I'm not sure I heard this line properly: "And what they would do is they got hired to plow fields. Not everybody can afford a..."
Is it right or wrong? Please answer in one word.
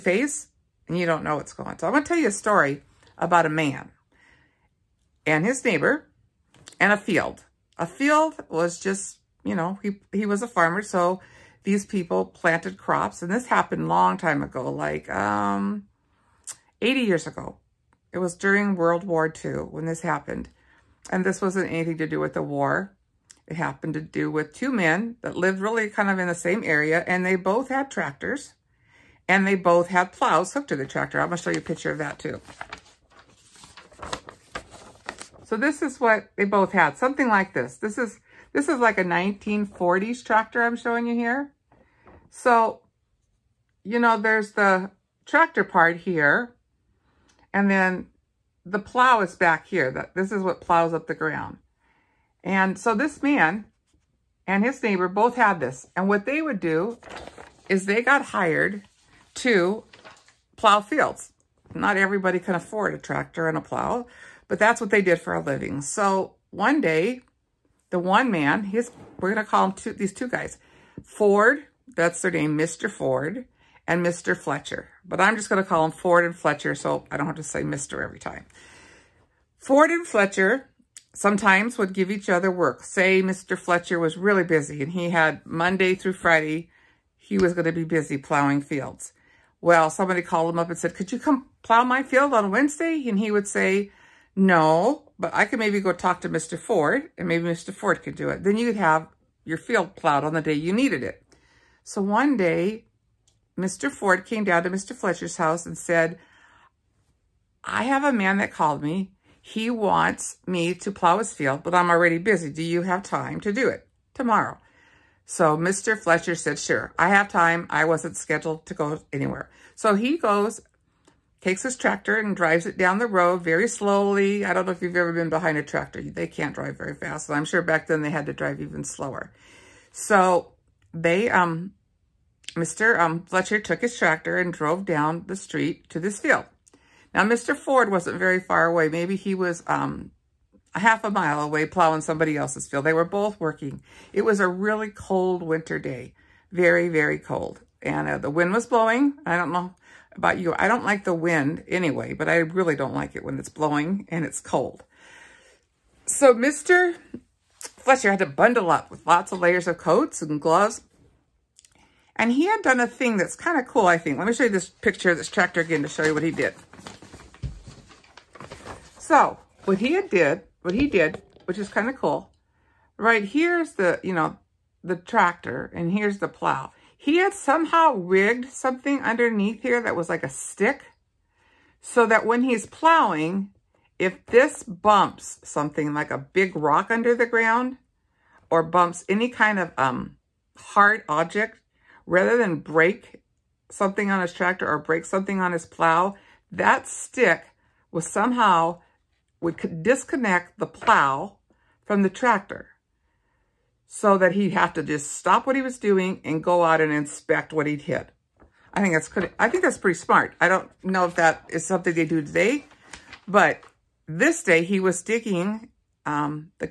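right.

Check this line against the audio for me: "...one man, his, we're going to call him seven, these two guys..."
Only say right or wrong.
wrong.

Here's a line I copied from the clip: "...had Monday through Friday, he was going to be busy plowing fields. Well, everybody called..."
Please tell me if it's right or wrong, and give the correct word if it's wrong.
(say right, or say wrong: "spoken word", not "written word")
wrong: "somebody", not "everybody".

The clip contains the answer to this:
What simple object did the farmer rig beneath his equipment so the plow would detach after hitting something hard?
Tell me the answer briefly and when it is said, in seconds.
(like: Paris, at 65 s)
a stick, at 180 s.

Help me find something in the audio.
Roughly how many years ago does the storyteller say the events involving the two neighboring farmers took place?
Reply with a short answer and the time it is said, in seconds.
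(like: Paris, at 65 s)
80 years, at 16 s.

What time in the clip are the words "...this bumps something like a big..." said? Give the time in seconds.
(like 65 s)
184 s.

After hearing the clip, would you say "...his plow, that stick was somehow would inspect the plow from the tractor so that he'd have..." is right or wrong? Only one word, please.
wrong.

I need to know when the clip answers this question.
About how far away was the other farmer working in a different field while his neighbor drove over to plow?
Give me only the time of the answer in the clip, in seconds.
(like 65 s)
140 s.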